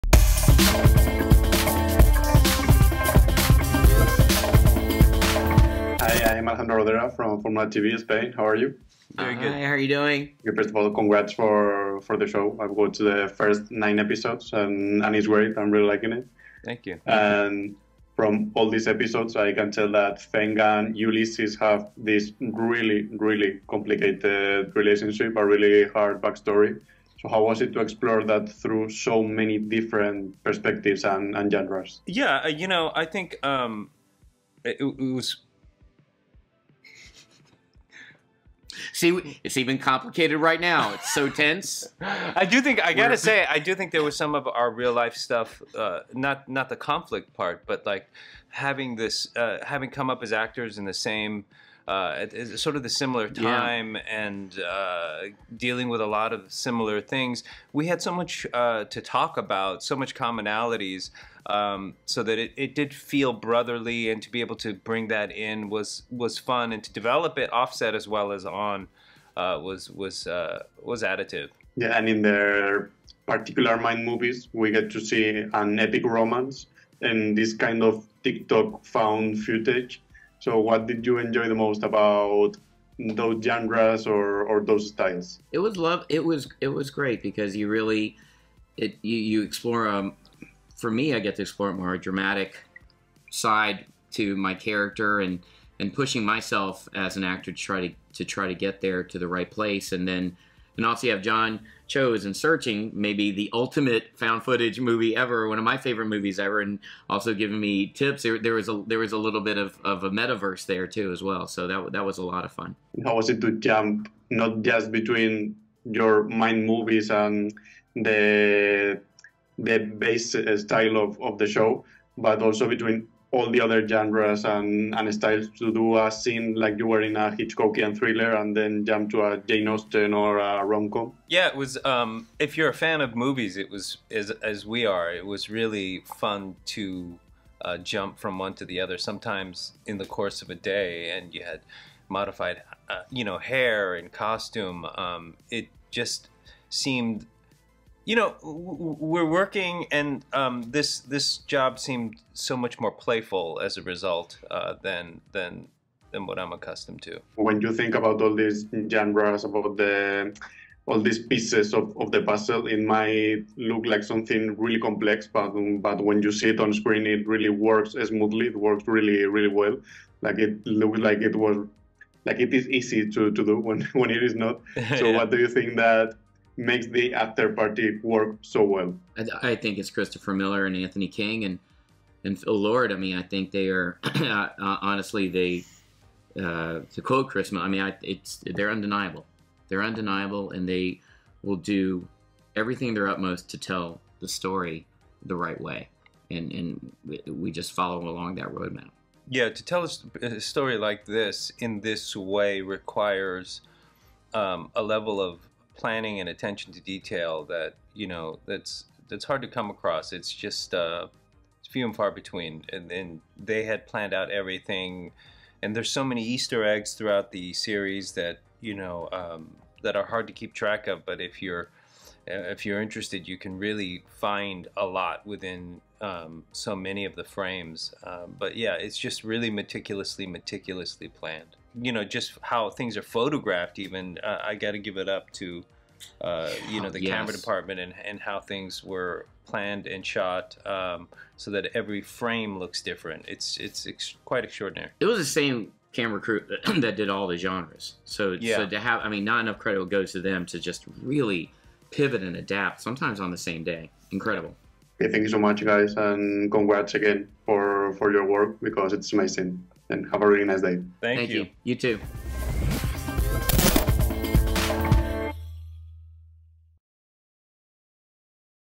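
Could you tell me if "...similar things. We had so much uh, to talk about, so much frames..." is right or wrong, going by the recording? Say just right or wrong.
wrong.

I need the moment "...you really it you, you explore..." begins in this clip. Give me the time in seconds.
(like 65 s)
87 s.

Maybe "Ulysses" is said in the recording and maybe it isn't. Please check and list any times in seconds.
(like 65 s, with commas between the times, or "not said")
20 s.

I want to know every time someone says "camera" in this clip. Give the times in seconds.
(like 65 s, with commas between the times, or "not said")
237 s, 245 s.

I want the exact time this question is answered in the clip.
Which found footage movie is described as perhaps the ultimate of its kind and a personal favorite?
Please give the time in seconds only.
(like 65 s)
102 s.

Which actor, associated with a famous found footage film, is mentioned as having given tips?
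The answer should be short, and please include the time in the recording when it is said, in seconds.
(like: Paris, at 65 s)
John Cho, at 101 s.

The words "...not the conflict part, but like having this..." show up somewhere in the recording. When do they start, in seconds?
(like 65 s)
46 s.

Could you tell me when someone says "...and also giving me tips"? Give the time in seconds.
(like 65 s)
106 s.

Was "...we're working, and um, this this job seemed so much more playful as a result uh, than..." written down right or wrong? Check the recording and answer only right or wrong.
right.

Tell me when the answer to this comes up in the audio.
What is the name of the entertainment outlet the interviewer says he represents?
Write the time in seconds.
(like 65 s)
7 s.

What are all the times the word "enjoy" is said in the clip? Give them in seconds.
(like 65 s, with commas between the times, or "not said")
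81 s.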